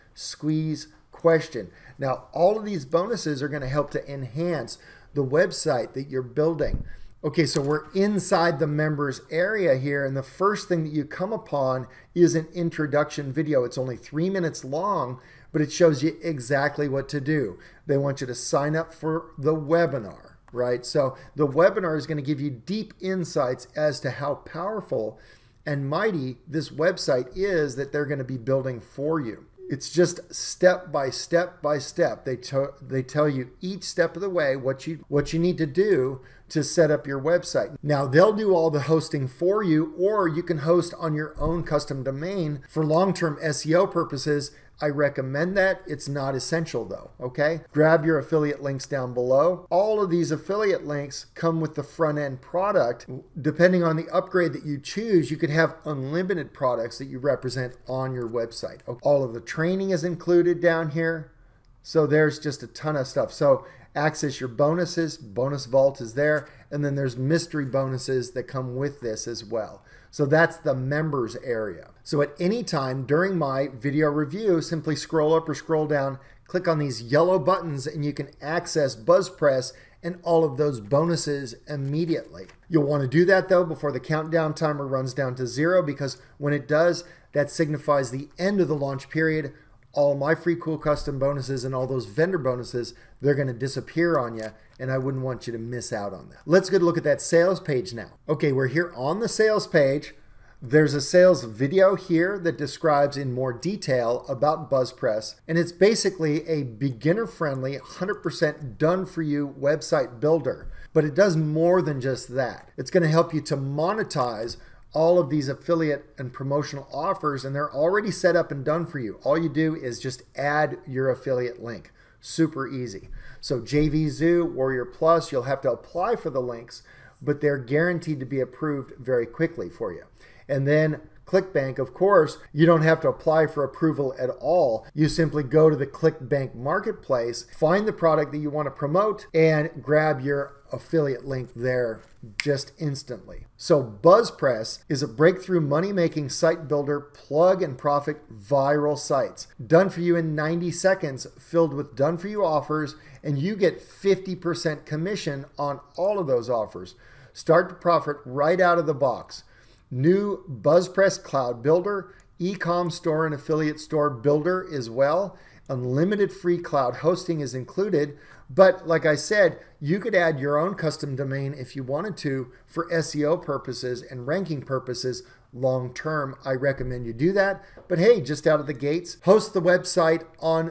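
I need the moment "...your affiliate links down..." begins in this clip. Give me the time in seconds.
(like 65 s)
48 s.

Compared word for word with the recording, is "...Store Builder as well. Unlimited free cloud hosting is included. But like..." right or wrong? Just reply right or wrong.
right.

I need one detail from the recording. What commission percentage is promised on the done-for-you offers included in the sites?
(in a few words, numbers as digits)
50%.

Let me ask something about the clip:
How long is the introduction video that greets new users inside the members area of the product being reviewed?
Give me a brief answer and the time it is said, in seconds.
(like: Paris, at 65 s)
3 minutes, at 13 s.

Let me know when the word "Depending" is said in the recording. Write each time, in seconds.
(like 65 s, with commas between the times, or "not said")
53 s.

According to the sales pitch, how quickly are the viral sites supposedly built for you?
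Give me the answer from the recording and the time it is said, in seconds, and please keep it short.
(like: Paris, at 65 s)
90 seconds, at 150 s.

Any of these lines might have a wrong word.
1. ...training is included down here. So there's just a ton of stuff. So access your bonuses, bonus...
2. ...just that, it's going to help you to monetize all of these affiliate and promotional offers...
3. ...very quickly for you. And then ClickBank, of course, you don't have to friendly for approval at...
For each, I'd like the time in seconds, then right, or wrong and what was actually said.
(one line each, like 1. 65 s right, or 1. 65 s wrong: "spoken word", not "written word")
1. 59 s right
2. 112 s right
3. 128 s wrong: "apply", not "friendly".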